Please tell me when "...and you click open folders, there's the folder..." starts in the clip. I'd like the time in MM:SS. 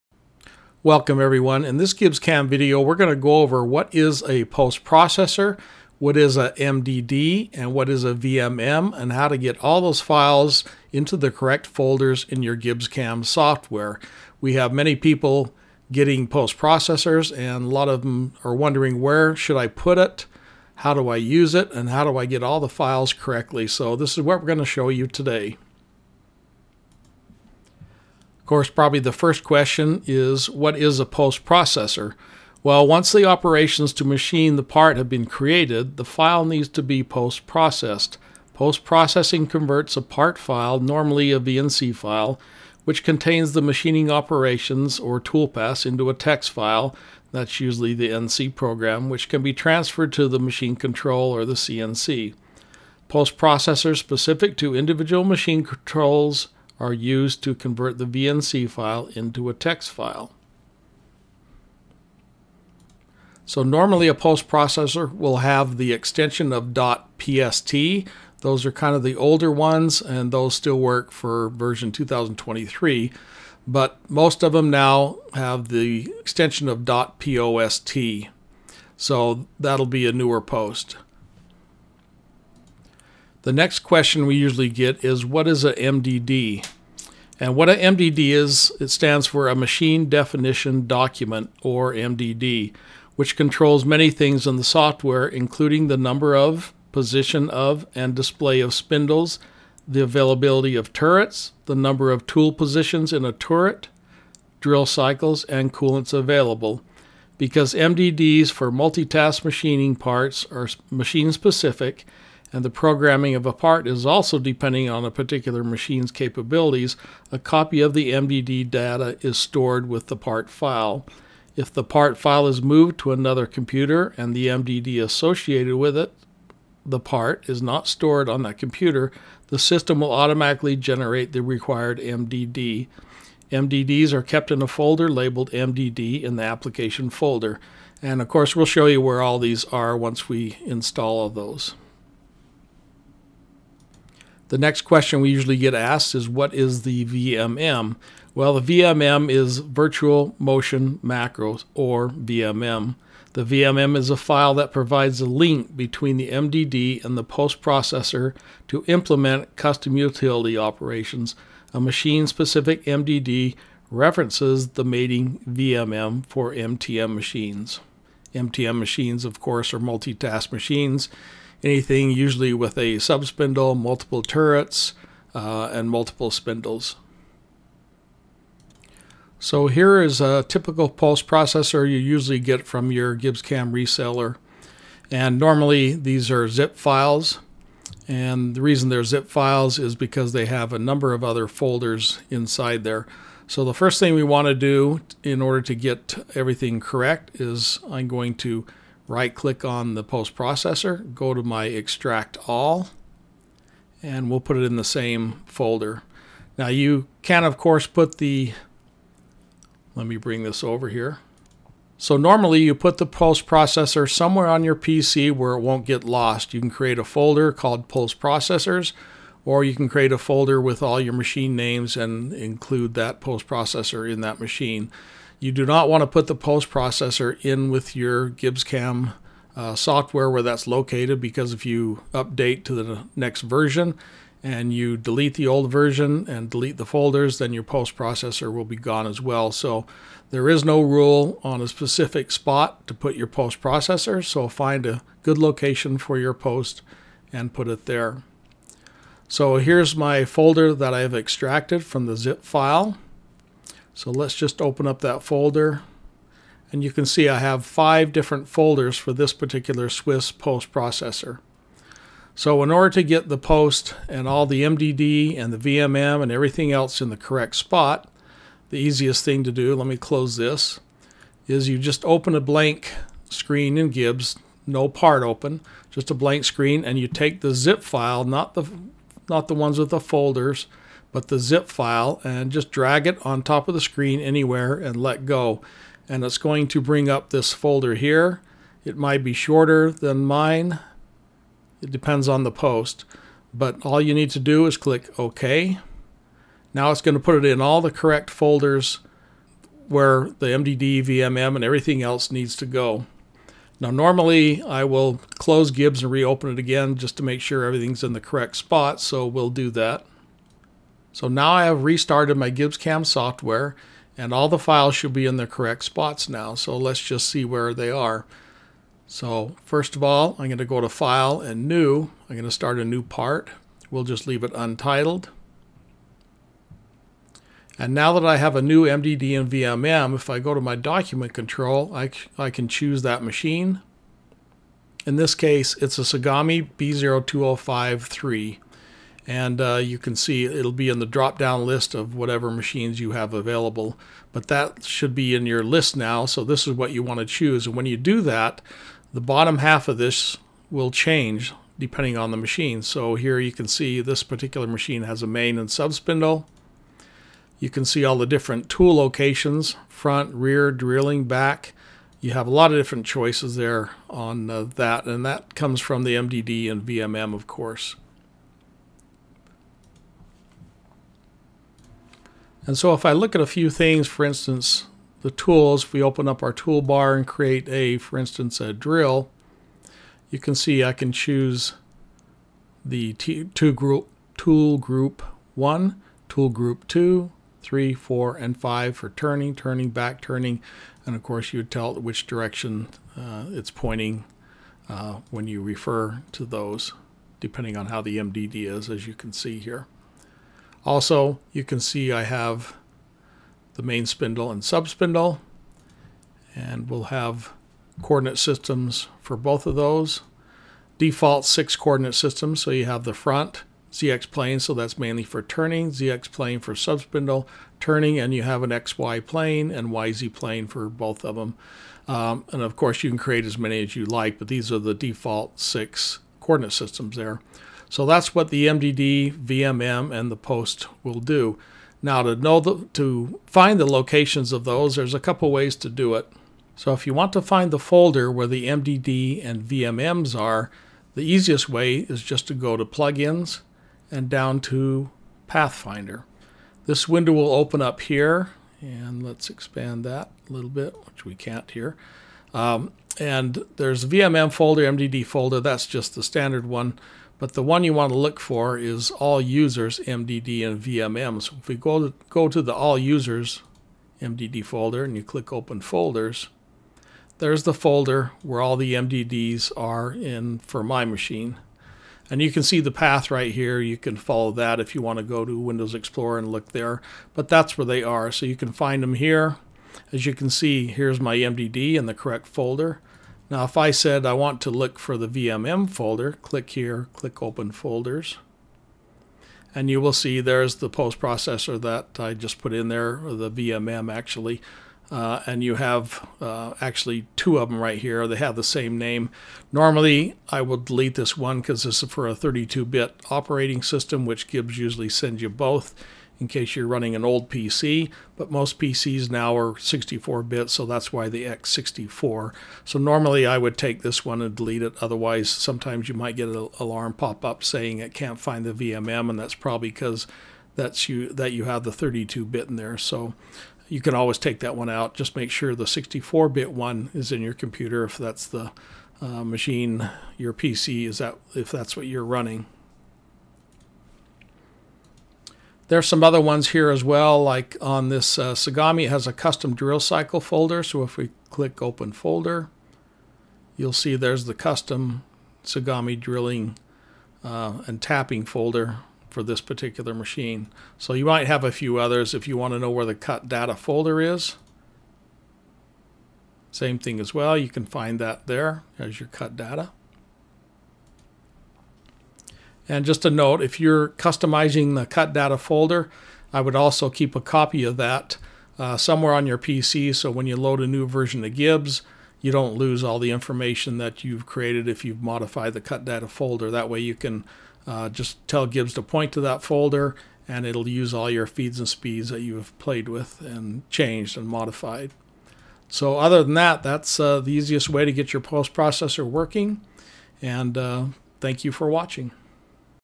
07:45.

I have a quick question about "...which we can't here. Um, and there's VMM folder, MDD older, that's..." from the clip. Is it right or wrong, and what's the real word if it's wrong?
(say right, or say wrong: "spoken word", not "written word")
wrong: "folder", not "older".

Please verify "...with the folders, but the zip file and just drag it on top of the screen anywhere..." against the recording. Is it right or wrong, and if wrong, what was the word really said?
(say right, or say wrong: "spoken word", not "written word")
right.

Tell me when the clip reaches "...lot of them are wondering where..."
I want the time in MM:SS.
00:17.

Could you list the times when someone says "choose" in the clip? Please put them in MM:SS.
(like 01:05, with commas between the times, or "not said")
05:32, 05:47, 06:21.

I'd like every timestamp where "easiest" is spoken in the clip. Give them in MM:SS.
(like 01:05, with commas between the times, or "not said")
04:28, 07:21, 09:47.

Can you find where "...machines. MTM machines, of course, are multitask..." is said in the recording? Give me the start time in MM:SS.
02:47.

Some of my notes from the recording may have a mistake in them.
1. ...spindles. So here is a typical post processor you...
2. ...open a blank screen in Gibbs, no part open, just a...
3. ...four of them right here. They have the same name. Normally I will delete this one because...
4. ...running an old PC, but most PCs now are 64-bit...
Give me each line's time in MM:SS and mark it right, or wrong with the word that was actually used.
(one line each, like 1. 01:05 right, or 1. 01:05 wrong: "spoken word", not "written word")
1. 02:56 right
2. 04:32 right
3. 08:17 wrong: "two", not "four"
4. 08:26 right.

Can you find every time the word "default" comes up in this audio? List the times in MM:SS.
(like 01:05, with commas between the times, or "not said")
06:50, 07:04.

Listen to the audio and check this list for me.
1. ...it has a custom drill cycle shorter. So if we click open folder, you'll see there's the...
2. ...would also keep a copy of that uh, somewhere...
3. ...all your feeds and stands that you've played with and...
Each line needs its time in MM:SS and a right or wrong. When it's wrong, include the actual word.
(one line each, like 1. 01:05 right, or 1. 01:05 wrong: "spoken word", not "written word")
1. 08:59 wrong: "folder", not "shorter"
2. 09:26 right
3. 09:41 wrong: "speeds", not "stands".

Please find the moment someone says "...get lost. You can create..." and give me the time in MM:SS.
03:35.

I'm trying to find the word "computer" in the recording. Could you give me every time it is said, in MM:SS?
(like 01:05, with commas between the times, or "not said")
02:03, 02:08, 08:47.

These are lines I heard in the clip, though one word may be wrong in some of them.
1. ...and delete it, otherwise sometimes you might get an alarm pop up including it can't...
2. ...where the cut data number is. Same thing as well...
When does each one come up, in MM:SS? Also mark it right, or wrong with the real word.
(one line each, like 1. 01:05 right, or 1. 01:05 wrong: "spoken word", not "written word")
1. 08:34 wrong: "saying", not "including"
2. 09:12 wrong: "folder", not "number".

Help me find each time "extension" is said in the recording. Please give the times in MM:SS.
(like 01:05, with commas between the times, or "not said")
01:05, 01:16.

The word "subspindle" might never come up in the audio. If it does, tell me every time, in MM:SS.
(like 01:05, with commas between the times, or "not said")
02:52, 06:44, 06:56.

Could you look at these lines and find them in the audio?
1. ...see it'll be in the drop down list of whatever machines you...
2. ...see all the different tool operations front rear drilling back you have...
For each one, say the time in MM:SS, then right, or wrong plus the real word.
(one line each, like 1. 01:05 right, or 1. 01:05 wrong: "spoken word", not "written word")
1. 05:40 right
2. 05:57 wrong: "locations", not "operations".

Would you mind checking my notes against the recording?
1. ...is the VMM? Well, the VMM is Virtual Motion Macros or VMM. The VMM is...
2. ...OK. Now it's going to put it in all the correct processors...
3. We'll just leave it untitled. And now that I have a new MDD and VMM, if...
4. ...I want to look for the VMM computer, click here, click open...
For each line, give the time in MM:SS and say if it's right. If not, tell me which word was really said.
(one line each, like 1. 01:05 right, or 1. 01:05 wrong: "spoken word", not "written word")
1. 02:26 right
2. 04:55 wrong: "folders", not "processors"
3. 05:23 right
4. 08:04 wrong: "folder", not "computer".